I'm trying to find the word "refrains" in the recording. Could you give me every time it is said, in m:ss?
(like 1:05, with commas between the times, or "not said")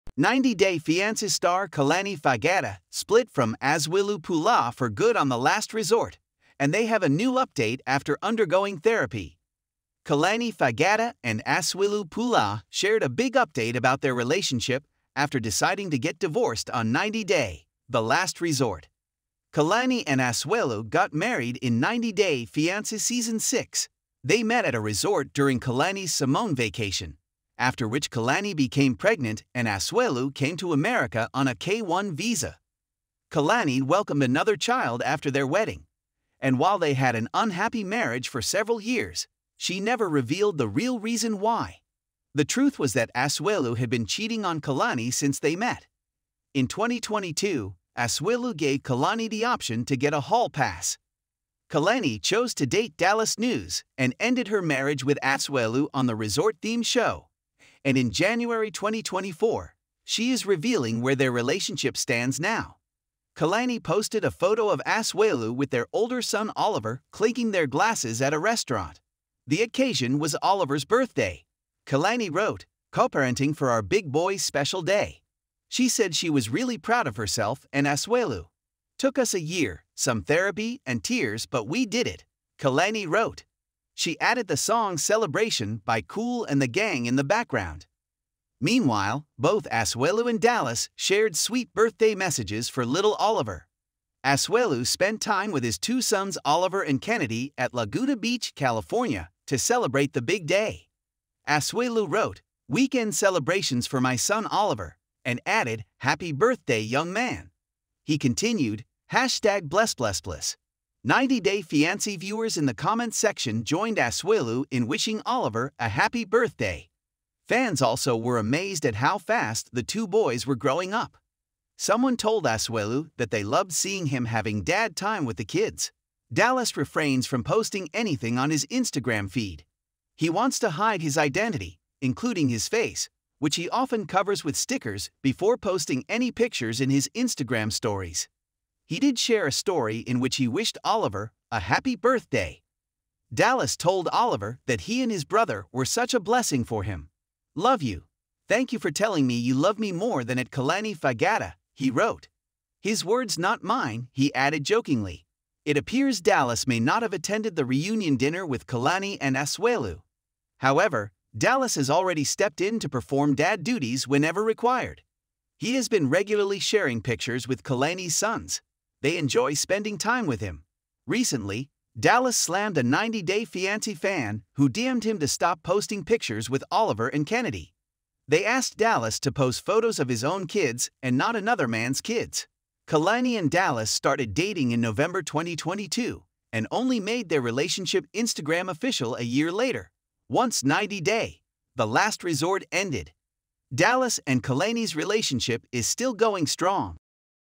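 2:06.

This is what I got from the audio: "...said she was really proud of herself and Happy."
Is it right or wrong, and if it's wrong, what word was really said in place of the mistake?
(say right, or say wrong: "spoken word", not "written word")
wrong: "Asuelu", not "Happy".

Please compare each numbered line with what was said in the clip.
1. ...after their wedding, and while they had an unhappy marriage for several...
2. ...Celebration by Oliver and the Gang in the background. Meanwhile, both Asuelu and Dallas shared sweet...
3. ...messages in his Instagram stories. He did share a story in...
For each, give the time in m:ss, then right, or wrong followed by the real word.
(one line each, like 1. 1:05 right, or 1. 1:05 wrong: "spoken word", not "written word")
1. 0:35 right
2. 1:24 wrong: "Kool", not "Oliver"
3. 2:16 wrong: "pictures", not "messages".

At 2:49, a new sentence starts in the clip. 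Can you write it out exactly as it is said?
They enjoy spending time with him.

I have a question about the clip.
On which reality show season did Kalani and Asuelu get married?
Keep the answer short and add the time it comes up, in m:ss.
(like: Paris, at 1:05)
90 Day Fiancé Season 6, at 0:21.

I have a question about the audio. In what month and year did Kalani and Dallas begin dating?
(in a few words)
November 2022.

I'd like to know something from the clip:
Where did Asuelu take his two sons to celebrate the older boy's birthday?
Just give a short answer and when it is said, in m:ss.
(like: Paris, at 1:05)
Laguna Beach, California, at 1:37.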